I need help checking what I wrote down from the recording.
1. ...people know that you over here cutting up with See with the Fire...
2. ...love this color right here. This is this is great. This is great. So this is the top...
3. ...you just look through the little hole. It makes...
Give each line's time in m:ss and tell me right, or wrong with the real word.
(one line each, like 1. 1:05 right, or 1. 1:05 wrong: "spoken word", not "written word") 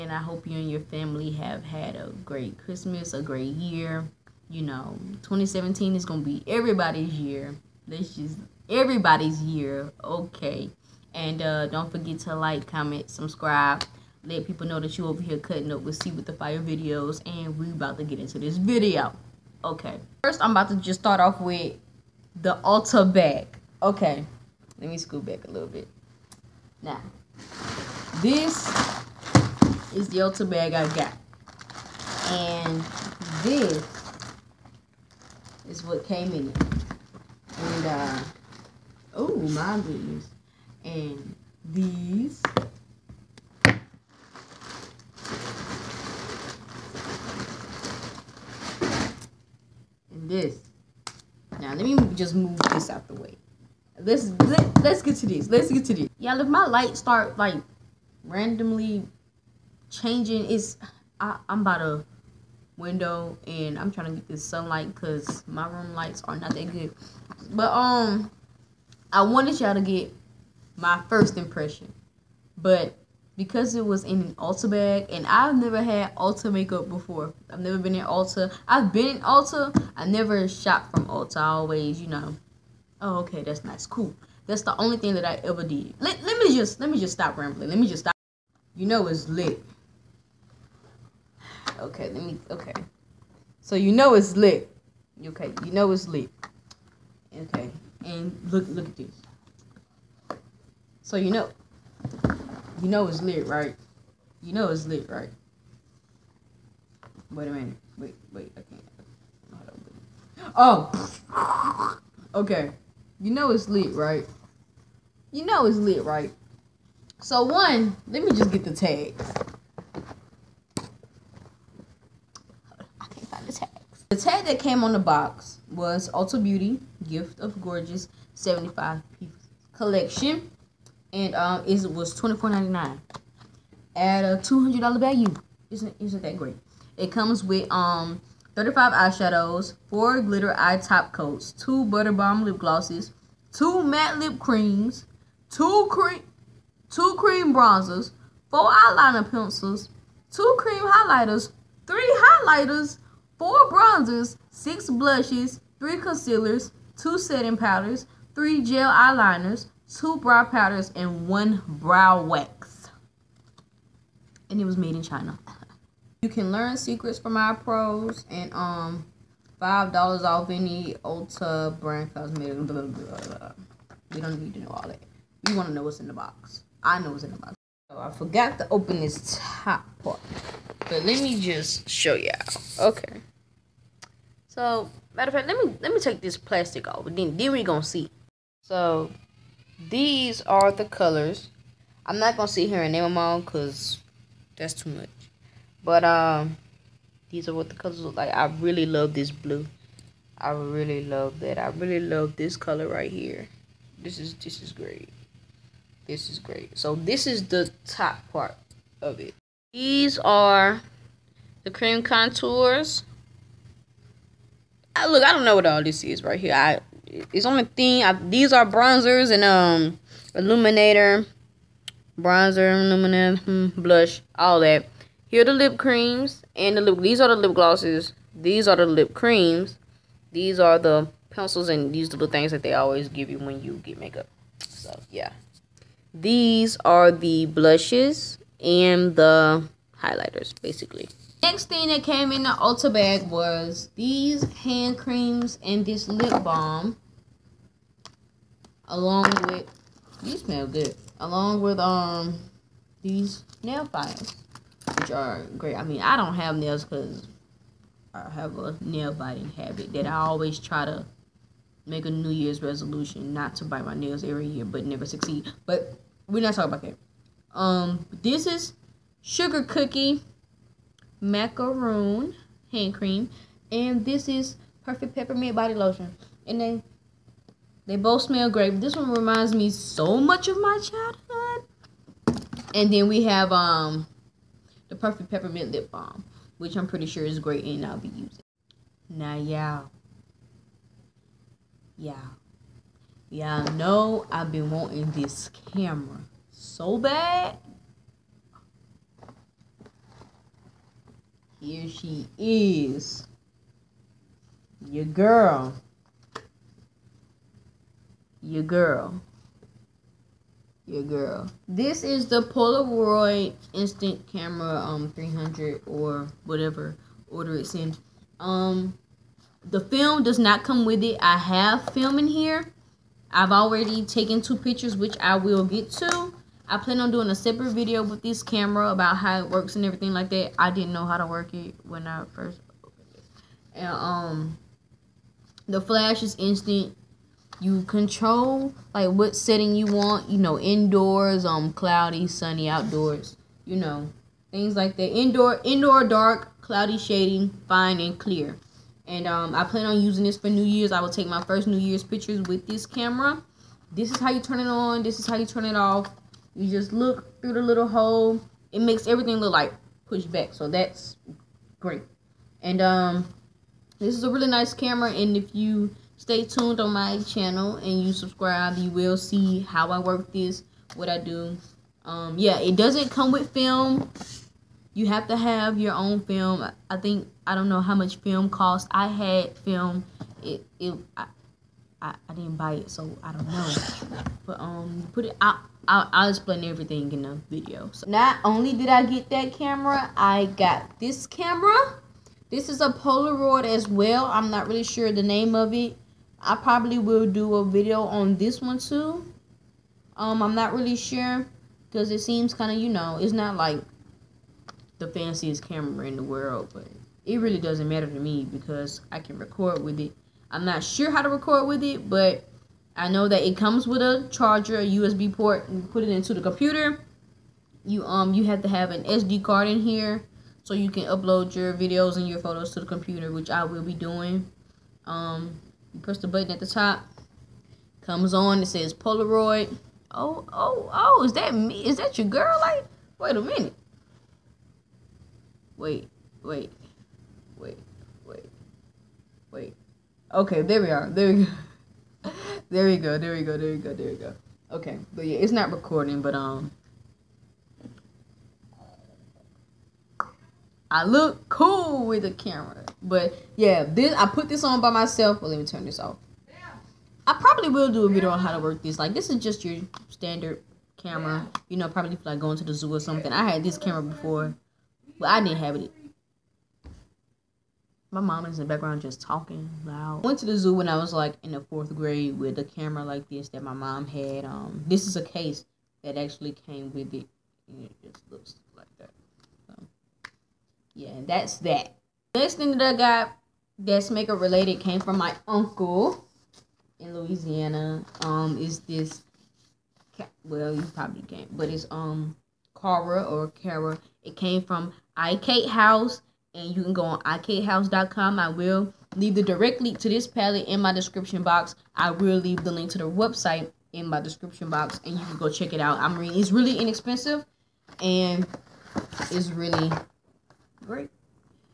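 1. 0:14 right
2. 3:21 right
3. 5:56 right.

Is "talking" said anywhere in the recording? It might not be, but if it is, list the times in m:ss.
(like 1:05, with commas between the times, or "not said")
4:26, 7:49.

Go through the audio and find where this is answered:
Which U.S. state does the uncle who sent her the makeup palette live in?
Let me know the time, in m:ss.
8:07.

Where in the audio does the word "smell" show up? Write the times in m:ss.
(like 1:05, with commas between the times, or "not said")
4:10, 4:38.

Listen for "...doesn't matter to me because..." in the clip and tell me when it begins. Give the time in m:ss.
6:47.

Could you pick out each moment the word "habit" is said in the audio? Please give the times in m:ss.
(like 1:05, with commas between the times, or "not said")
4:19.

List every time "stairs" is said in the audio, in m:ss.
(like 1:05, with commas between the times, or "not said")
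not said.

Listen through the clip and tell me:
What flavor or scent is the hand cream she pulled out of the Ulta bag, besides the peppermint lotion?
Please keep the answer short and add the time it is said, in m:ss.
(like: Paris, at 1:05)
Sugar cookie macaroon, at 4:29.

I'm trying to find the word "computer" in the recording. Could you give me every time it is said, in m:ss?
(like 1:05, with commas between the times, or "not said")
6:56, 7:02.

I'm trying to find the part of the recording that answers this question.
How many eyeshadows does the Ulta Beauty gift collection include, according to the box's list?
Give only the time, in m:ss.
2:18.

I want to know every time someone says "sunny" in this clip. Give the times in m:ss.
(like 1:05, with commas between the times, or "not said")
5:42.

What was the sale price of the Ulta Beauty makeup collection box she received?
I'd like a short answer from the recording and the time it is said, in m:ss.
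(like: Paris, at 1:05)
$24.99, at 2:12.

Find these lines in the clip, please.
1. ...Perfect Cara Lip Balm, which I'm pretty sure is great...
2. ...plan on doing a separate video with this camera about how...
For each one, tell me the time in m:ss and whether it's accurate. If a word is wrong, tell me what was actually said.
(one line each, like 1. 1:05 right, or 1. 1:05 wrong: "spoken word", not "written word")
1. 4:44 wrong: "Peppermint", not "Cara"
2. 5:26 right.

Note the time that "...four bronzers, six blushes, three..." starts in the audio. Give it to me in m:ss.
2:33.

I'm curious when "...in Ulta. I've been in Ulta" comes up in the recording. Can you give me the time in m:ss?
1:17.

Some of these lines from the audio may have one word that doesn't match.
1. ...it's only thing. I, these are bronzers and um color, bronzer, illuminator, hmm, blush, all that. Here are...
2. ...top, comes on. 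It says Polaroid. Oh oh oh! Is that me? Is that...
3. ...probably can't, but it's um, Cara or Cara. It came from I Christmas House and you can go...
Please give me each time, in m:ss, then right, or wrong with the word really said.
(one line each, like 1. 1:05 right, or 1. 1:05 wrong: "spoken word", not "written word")
1. 3:37 wrong: "illuminator", not "color"
2. 7:06 right
3. 8:10 wrong: "Kate", not "Christmas".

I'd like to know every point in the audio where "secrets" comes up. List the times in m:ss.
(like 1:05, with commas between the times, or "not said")
2:46.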